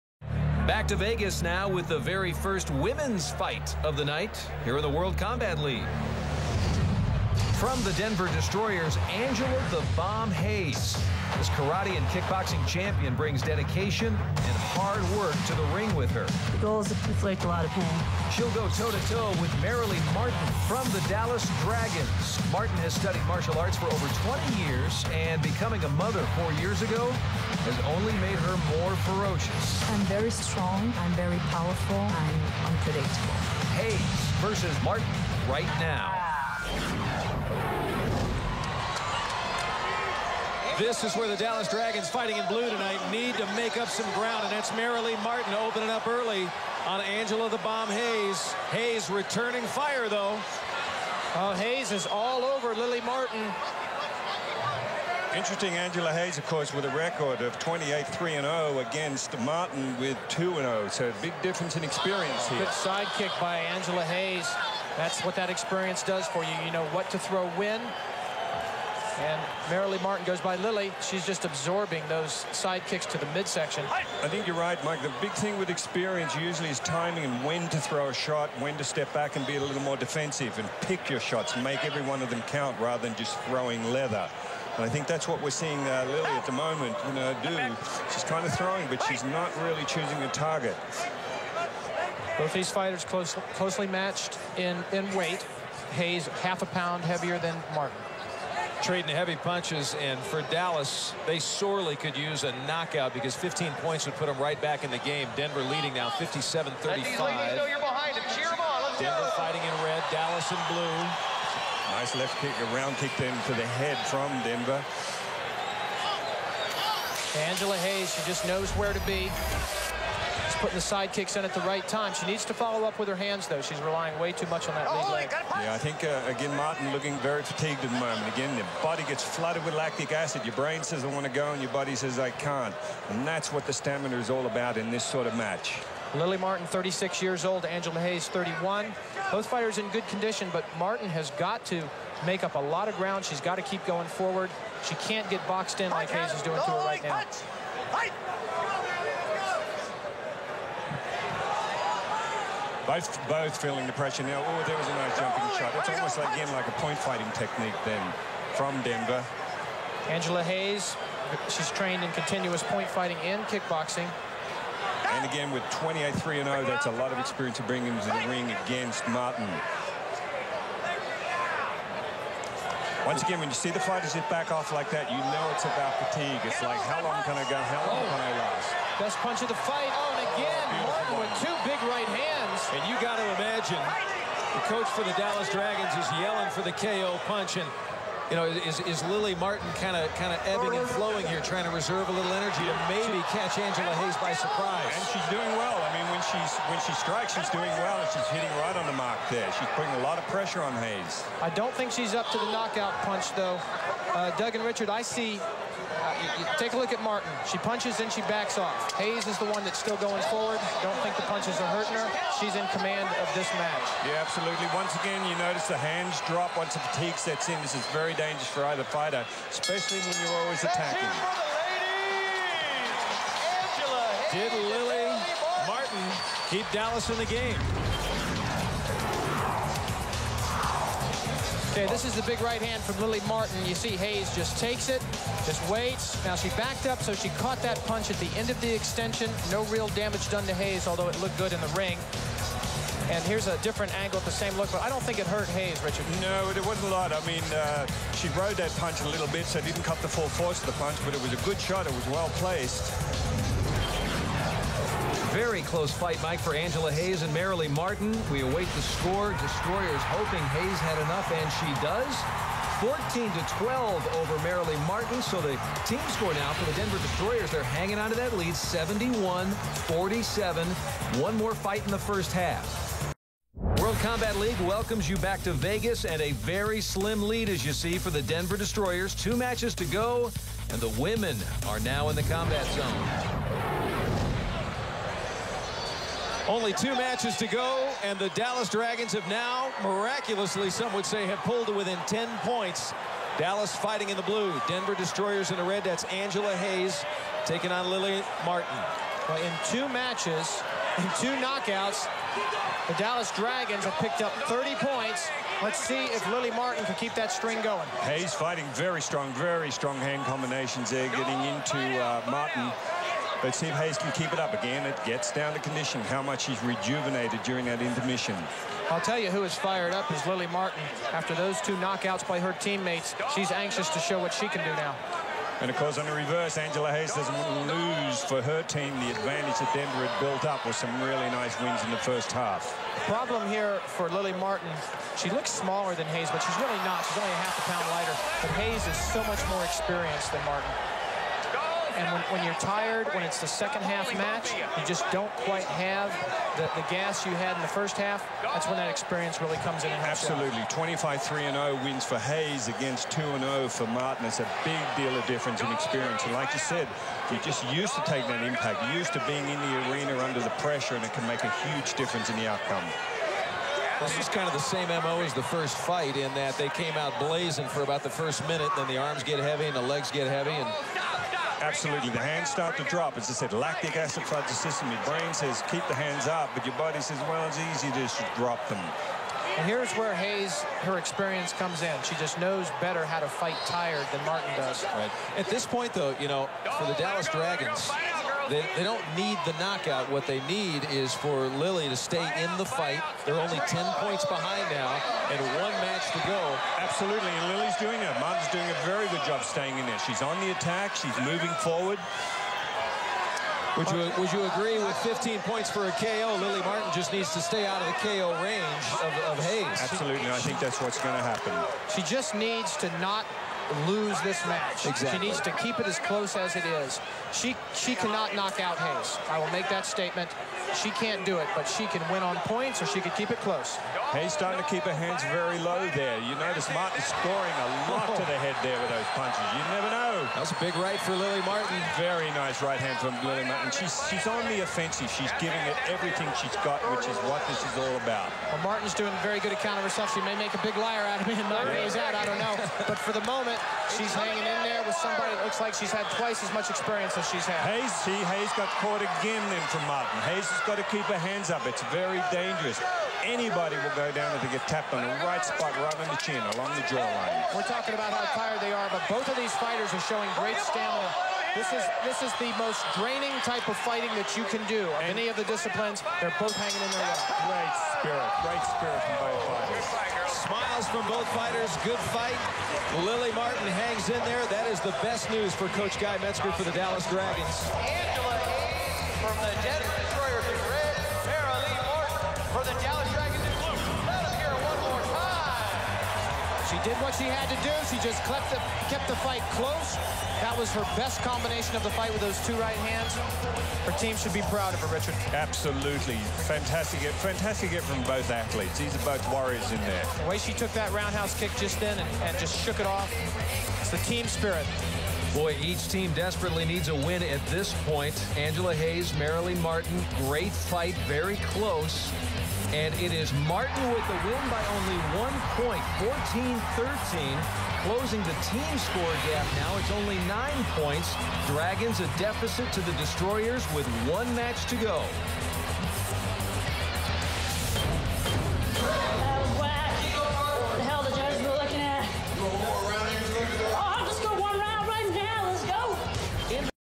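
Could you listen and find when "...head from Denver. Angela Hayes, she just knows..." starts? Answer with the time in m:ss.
1:53.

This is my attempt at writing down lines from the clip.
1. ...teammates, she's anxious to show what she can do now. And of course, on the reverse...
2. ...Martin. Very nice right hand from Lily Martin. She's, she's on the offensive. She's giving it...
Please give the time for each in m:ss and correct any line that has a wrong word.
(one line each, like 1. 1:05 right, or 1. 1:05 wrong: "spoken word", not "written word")
1. 5:22 right
2. 7:11 right.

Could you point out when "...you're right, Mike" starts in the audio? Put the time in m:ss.
1:14.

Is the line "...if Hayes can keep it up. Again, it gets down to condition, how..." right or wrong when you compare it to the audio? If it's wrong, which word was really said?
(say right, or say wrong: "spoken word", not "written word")
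right.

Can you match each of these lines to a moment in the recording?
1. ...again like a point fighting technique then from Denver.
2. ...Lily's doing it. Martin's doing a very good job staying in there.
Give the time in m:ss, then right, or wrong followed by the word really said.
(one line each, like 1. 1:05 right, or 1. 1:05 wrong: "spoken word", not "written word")
1. 2:36 right
2. 6:37 right.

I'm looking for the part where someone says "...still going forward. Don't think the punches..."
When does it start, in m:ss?
3:29.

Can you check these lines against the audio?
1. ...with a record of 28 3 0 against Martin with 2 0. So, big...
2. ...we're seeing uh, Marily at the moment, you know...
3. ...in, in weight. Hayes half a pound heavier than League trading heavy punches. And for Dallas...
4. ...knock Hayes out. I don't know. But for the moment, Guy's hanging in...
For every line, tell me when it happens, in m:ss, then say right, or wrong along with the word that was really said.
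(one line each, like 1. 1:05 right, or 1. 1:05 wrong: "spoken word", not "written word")
1. 0:56 right
2. 1:25 wrong: "Lily", not "Marily"
3. 1:34 wrong: "Martin", not "League"
4. 7:21 wrong: "She", not "Guy".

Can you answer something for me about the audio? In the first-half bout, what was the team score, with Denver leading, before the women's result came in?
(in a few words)
57-35.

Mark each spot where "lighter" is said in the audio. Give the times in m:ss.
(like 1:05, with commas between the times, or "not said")
5:37.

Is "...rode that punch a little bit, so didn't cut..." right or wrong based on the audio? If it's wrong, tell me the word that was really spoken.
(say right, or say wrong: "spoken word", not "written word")
right.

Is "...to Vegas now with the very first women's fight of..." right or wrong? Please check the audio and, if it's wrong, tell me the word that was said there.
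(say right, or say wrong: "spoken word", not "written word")
right.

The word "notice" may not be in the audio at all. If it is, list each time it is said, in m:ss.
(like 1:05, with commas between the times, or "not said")
3:35, 7:06.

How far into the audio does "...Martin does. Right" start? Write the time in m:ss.
6:24.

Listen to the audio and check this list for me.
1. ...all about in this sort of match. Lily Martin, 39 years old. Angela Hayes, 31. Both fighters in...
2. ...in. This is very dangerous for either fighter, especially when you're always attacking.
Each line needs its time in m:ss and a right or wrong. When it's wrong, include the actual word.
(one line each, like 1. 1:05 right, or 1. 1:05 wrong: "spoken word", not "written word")
1. 2:14 wrong: "36", not "39"
2. 3:37 right.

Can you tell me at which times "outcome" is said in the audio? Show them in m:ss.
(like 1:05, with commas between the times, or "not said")
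6:02.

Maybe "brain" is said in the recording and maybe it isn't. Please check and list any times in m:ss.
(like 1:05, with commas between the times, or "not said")
2:10, 6:15.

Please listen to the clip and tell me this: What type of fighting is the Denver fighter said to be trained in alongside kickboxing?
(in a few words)
Continuous point fighting.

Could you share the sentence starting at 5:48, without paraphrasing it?
That's when that experience really comes in.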